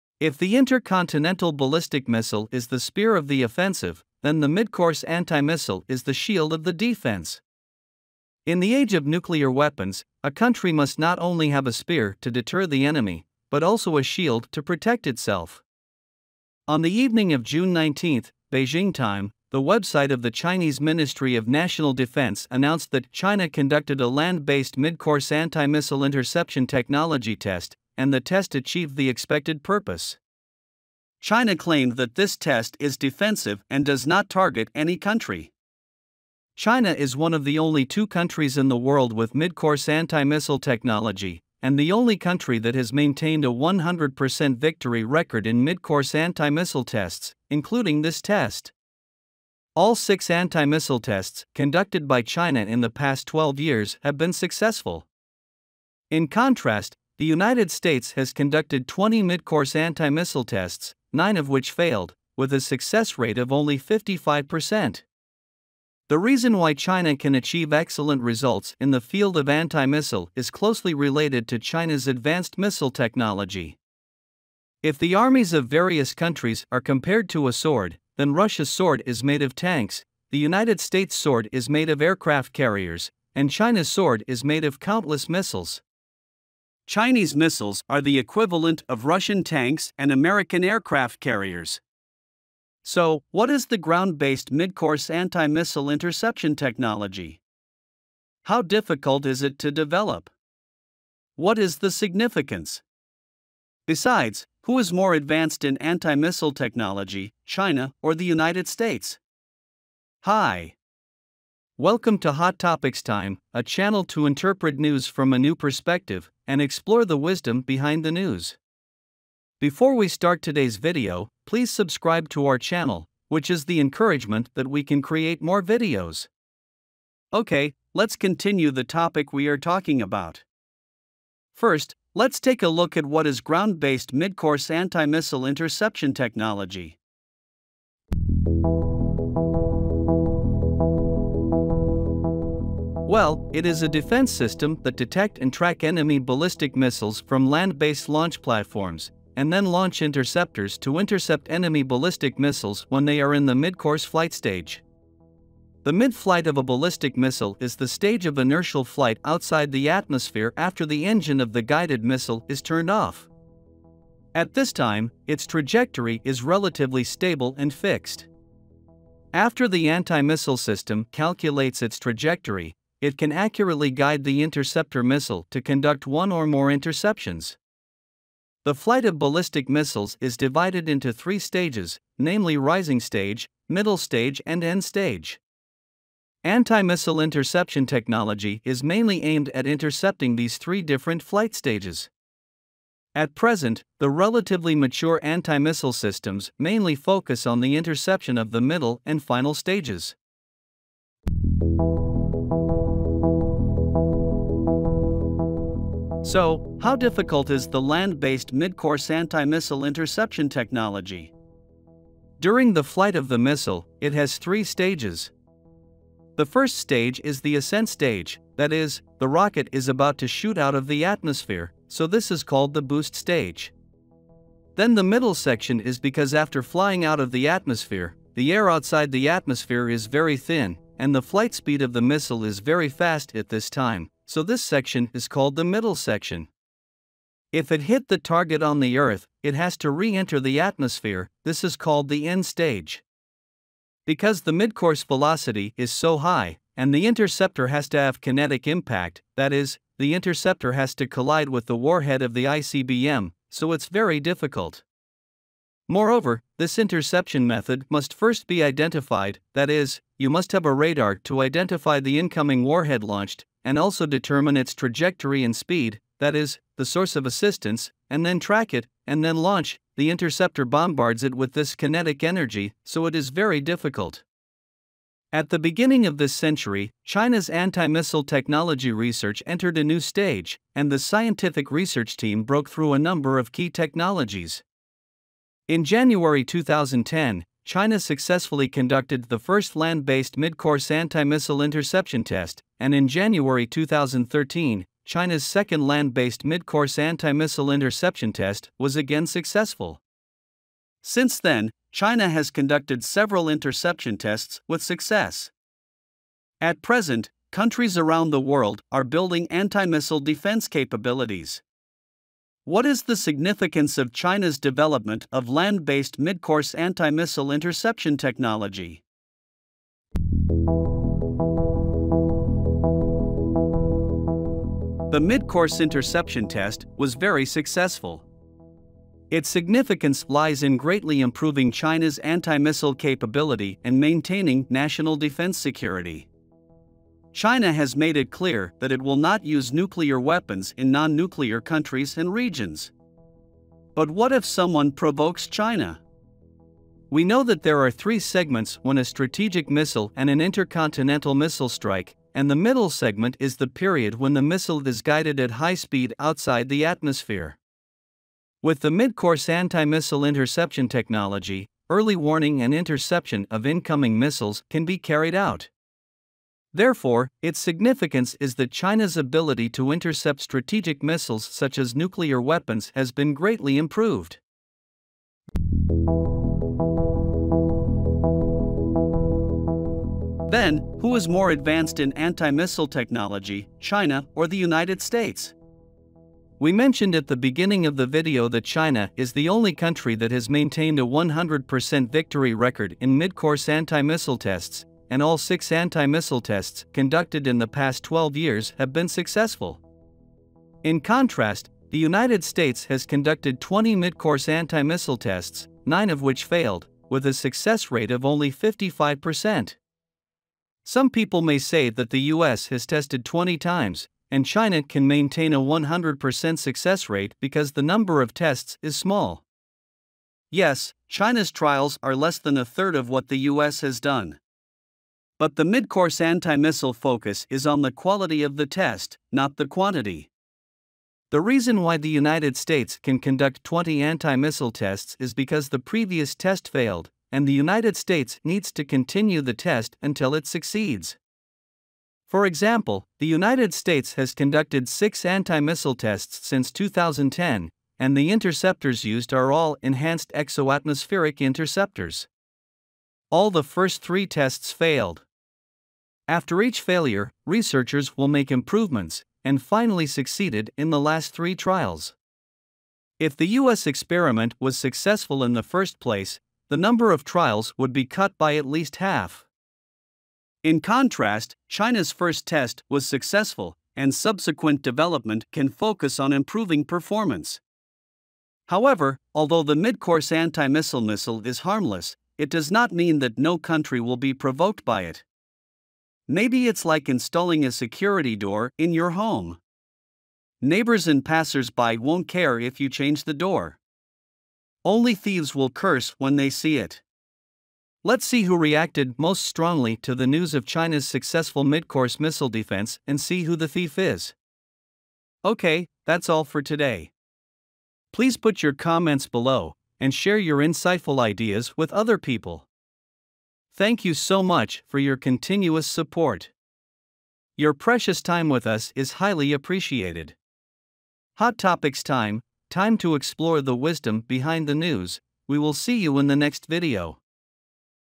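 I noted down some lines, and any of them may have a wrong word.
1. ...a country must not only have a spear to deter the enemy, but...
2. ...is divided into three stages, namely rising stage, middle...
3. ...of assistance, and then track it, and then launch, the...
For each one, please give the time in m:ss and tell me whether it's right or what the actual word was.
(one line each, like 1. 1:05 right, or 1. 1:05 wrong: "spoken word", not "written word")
1. 0:10 right
2. 3:00 right
3. 4:27 right.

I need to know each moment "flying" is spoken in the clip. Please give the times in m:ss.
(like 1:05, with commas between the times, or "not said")
3:46.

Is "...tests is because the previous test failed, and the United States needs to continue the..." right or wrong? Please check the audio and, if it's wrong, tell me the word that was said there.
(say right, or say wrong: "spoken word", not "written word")
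right.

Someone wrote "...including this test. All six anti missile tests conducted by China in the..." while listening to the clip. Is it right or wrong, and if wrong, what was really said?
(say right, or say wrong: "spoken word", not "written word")
right.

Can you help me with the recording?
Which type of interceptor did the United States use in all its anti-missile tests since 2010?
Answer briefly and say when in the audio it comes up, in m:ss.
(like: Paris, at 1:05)
enhanced exoatmospheric interceptors, at 7:29.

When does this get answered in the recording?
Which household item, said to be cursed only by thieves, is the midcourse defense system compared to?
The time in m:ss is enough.
8:07.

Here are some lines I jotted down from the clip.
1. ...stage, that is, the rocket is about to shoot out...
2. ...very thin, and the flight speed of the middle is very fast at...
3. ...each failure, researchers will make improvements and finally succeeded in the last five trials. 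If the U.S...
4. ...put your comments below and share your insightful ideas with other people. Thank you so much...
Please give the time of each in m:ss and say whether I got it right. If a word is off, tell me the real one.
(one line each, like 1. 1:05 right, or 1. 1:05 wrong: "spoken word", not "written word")
1. 3:37 right
2. 3:50 wrong: "missile", not "middle"
3. 7:36 wrong: "three", not "five"
4. 8:28 right.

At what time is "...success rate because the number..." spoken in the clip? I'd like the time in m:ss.
6:56.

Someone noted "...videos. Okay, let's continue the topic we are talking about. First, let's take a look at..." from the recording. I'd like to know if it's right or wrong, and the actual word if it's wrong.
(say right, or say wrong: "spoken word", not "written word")
right.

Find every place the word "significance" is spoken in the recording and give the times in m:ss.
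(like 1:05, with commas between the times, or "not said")
1:41, 5:13, 5:29, 6:07.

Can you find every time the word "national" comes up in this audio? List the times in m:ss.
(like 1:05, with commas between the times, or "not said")
0:21, 5:34.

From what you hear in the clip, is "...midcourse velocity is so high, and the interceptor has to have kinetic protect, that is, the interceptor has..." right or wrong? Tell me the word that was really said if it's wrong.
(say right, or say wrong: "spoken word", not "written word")
wrong: "impact", not "protect".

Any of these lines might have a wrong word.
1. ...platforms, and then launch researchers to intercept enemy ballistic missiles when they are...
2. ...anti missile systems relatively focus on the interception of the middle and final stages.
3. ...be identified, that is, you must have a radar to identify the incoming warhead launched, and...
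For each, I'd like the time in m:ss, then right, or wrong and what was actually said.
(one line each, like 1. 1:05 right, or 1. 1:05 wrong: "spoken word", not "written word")
1. 2:28 wrong: "interceptors", not "researchers"
2. 3:15 wrong: "mainly", not "relatively"
3. 4:18 right.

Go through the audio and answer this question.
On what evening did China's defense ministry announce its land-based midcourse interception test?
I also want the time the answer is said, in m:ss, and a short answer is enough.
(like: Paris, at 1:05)
June 19, at 0:17.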